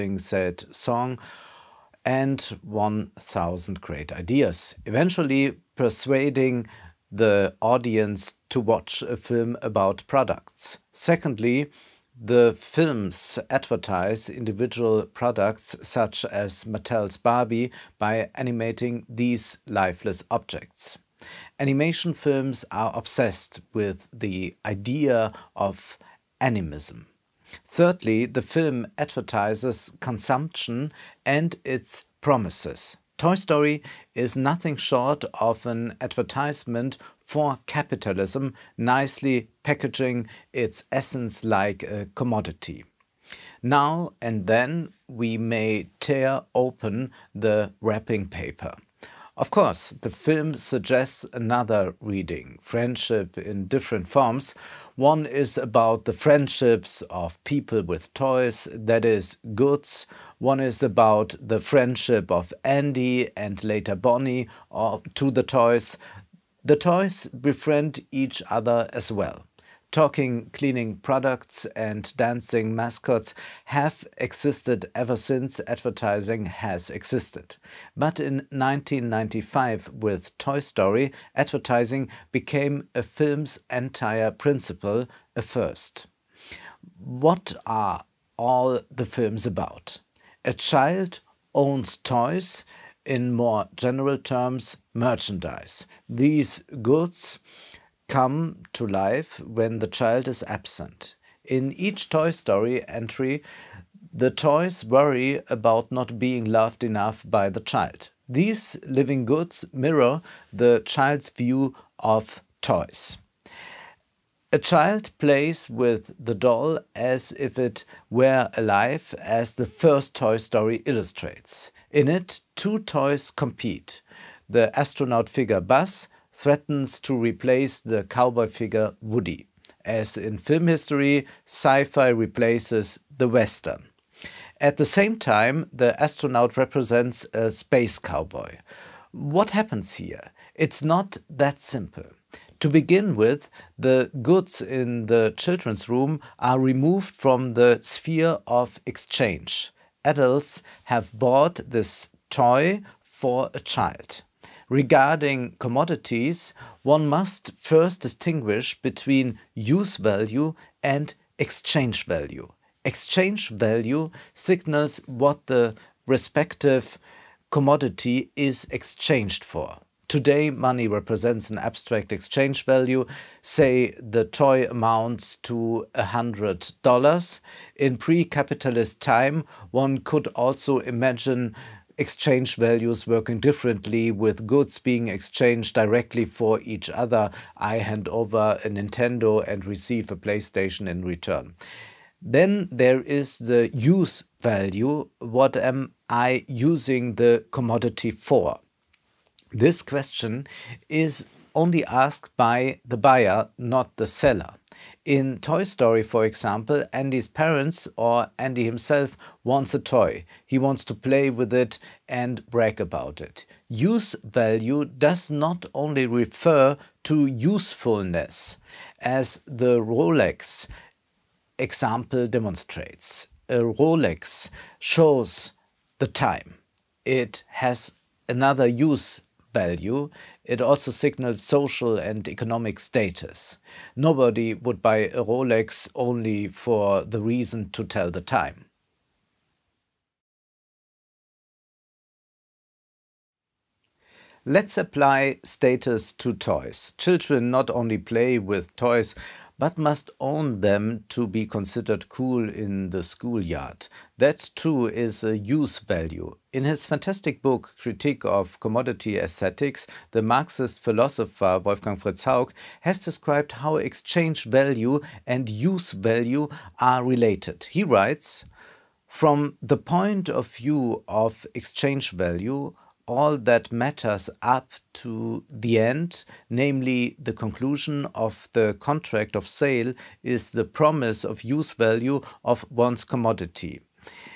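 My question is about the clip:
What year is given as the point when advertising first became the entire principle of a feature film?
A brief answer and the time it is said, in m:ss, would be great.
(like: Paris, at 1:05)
1995, at 1:18.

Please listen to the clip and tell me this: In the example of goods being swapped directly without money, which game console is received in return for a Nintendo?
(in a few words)
PlayStation.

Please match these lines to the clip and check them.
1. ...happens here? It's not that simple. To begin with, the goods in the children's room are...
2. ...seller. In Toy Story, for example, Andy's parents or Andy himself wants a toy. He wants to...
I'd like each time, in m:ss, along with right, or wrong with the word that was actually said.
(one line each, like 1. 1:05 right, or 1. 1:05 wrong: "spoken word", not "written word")
1. 2:19 right
2. 3:24 right.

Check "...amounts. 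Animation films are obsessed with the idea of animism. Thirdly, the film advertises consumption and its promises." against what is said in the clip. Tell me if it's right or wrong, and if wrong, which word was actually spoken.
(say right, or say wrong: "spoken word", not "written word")
wrong: "objects", not "amounts".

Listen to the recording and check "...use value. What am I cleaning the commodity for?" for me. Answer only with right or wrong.
wrong.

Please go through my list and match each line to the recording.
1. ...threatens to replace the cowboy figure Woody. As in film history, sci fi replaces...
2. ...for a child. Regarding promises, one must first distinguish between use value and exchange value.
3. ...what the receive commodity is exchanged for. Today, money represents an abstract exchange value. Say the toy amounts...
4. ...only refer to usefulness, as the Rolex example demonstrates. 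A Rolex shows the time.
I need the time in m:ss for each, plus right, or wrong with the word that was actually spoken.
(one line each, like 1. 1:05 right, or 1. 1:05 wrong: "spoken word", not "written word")
1. 2:06 right
2. 2:33 wrong: "commodities", not "promises"
3. 2:45 wrong: "respective", not "receive"
4. 3:35 right.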